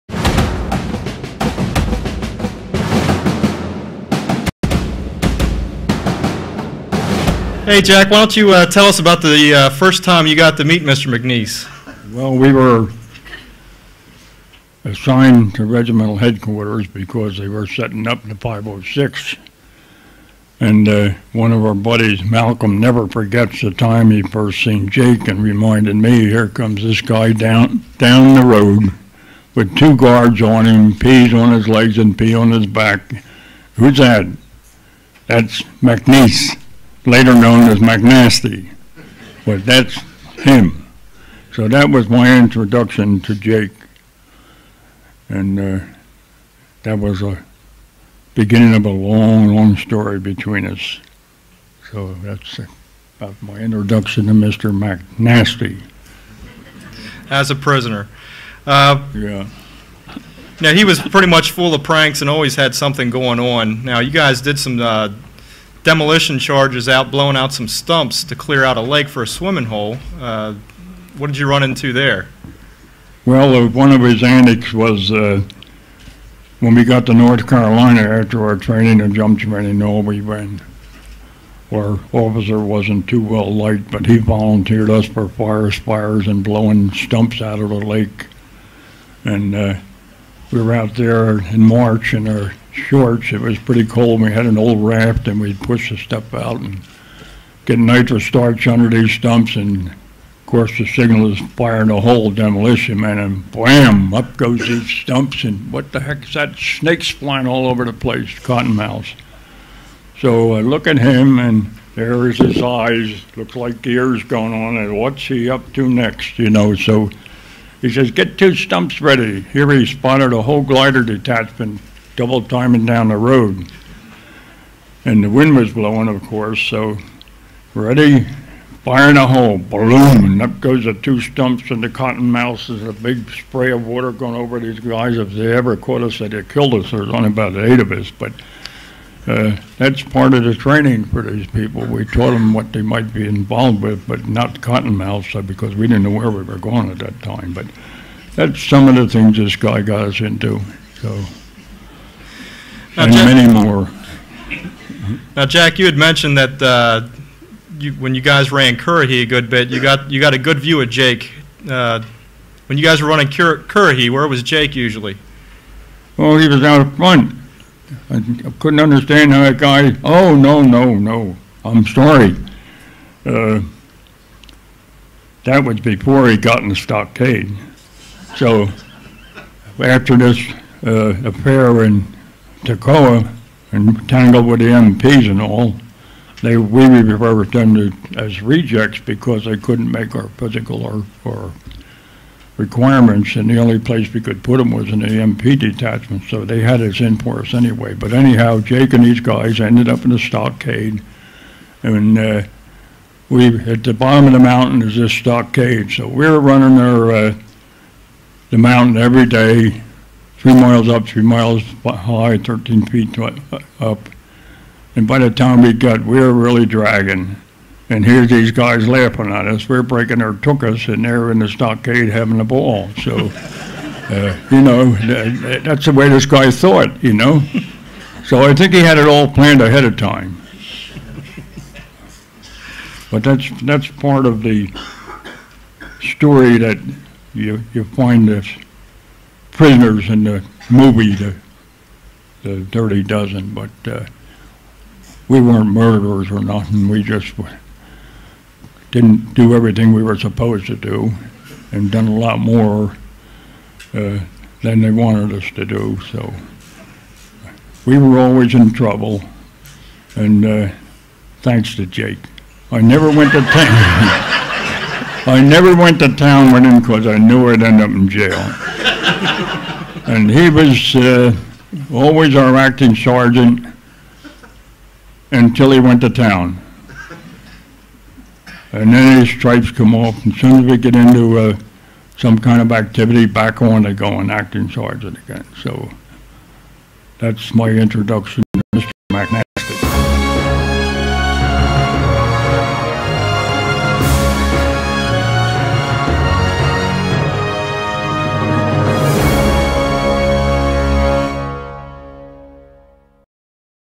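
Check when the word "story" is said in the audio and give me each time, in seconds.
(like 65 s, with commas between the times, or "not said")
49 s, 236 s.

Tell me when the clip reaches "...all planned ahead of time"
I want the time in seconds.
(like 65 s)
229 s.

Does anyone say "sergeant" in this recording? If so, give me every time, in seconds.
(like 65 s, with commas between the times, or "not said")
272 s, 284 s.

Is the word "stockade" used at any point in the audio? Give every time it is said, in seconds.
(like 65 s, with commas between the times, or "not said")
176 s, 200 s, 205 s, 221 s.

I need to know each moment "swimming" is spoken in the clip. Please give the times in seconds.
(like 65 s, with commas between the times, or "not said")
69 s.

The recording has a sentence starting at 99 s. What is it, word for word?
And of course, the signal is firing the whole demolition man, and bam!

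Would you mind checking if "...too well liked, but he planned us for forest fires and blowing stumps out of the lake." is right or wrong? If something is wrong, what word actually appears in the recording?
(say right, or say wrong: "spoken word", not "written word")
wrong: "volunteered", not "planned".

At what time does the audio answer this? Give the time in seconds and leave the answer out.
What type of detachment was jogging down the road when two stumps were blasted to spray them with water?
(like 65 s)
120 s.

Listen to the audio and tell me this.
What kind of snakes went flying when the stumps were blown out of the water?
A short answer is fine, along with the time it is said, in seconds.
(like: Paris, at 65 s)
Cottonmouths, at 108 s.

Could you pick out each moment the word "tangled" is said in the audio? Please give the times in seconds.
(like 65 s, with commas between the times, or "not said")
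184 s.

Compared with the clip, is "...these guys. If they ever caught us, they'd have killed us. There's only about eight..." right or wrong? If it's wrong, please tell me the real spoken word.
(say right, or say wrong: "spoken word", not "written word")
right.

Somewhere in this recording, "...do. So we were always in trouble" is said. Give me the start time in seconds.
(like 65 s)
255 s.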